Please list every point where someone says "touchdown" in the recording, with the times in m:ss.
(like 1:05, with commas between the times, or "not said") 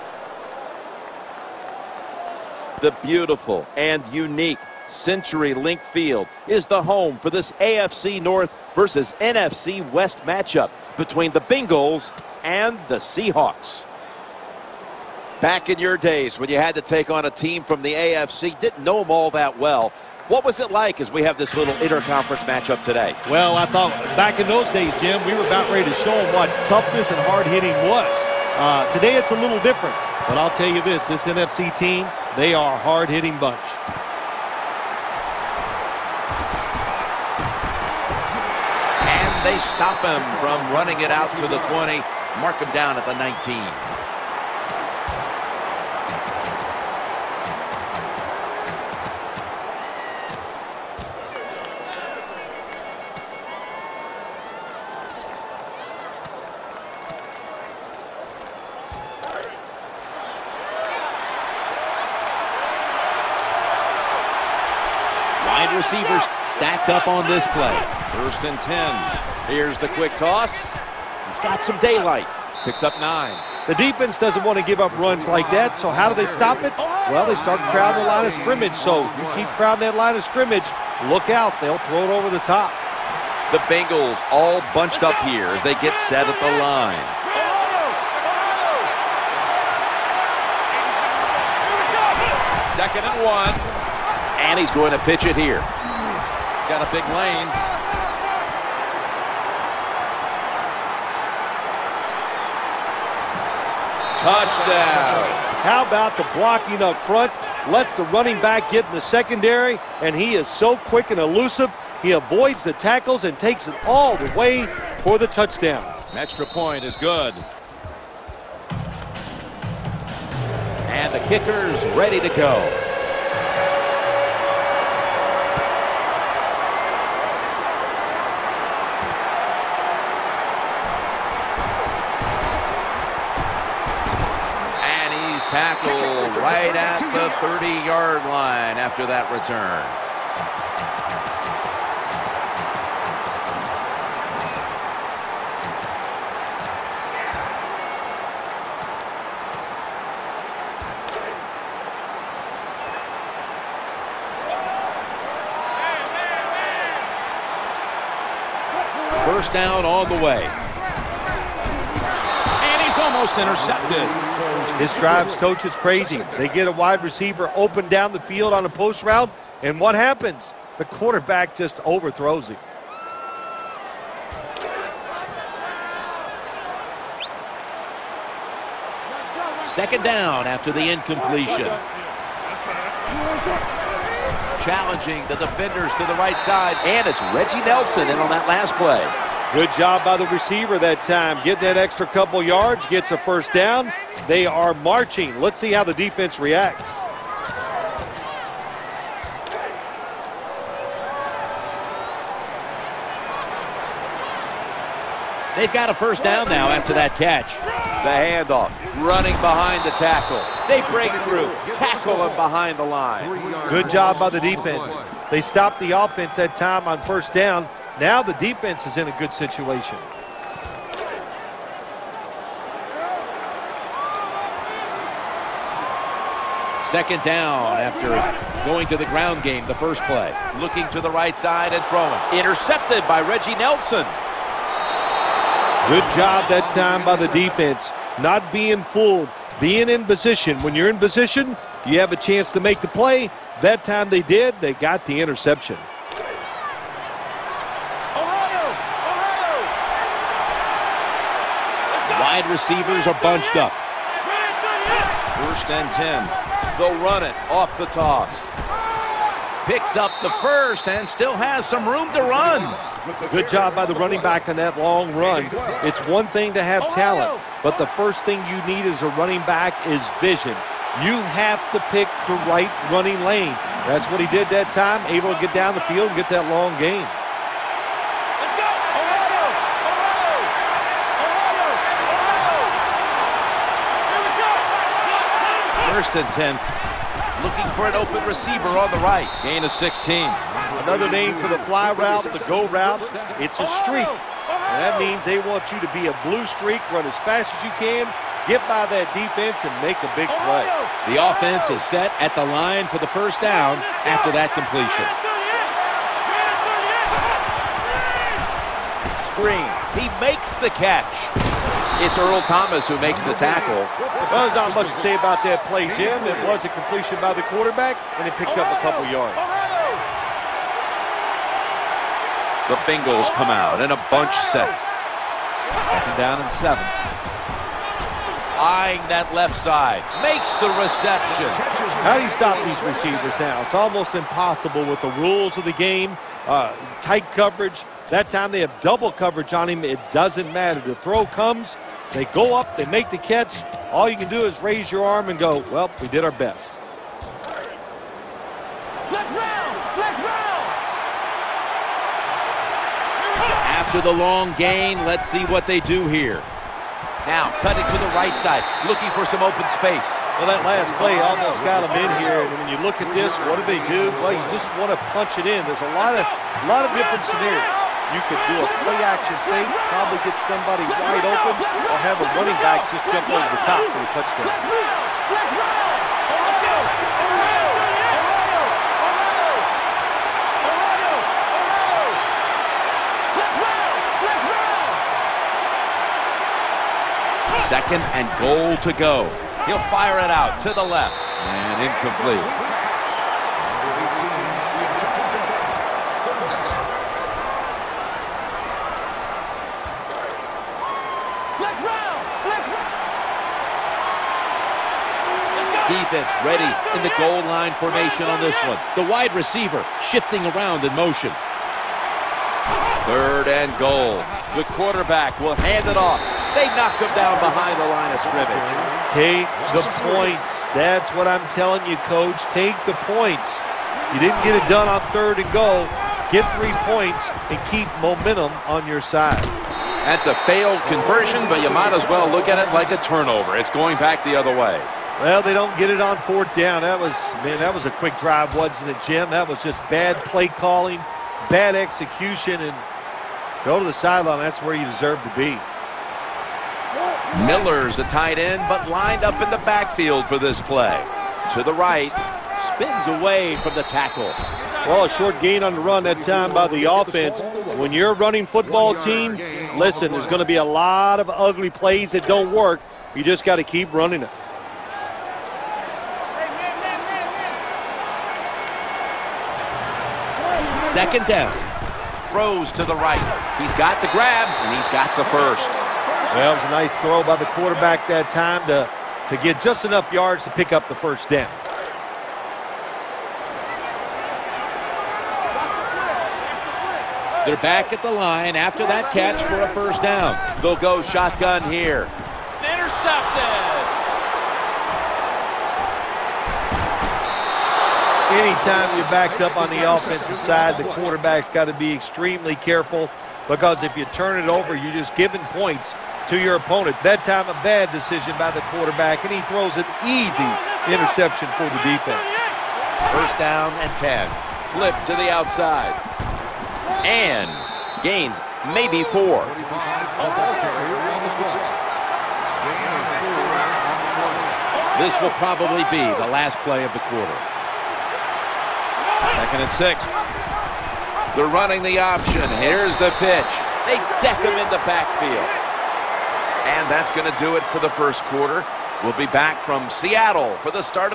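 1:44, 1:55, 6:14.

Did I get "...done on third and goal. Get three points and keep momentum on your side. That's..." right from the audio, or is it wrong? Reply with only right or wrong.
right.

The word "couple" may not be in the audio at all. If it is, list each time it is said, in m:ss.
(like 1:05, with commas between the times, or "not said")
3:12, 5:18.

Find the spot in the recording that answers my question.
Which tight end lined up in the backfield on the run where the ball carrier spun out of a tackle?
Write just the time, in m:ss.
7:27.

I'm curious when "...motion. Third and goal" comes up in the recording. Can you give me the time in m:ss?
6:50.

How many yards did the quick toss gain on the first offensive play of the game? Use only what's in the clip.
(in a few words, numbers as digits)
9.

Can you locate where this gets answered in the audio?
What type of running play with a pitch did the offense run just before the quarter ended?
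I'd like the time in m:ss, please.
8:51.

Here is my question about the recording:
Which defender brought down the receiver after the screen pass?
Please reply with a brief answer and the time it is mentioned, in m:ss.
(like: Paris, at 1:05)
Earl Thomas, at 5:12.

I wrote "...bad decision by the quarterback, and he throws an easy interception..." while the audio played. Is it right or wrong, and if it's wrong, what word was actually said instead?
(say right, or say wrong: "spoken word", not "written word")
right.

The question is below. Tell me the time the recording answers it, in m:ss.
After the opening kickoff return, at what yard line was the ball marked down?
0:43.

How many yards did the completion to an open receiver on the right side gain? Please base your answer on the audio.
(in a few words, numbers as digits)
16.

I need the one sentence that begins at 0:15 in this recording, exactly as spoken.
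Back in your days when you had to take on a team from the AFC, didn't know them all that well.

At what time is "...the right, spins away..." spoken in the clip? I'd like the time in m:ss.
7:31.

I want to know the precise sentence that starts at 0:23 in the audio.
Well, I thought back in those days, Jim, we were about ready to show them what toughness and hard hitting was.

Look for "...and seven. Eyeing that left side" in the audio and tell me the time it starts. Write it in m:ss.
5:26.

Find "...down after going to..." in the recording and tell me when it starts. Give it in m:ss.
3:47.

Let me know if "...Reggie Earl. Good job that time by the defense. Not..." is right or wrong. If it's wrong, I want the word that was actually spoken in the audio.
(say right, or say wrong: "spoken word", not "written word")
wrong: "Nelson", not "Earl".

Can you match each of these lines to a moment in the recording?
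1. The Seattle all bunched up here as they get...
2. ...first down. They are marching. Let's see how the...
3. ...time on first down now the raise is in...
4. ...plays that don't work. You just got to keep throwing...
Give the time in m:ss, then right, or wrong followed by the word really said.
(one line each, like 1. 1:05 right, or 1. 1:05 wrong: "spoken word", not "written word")
1. 1:23 wrong: "Bengals", not "Seattle"
2. 3:13 right
3. 3:36 wrong: "defense", not "raise"
4. 7:41 wrong: "running", not "throwing".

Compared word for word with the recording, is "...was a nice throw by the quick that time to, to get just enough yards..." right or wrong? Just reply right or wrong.
wrong.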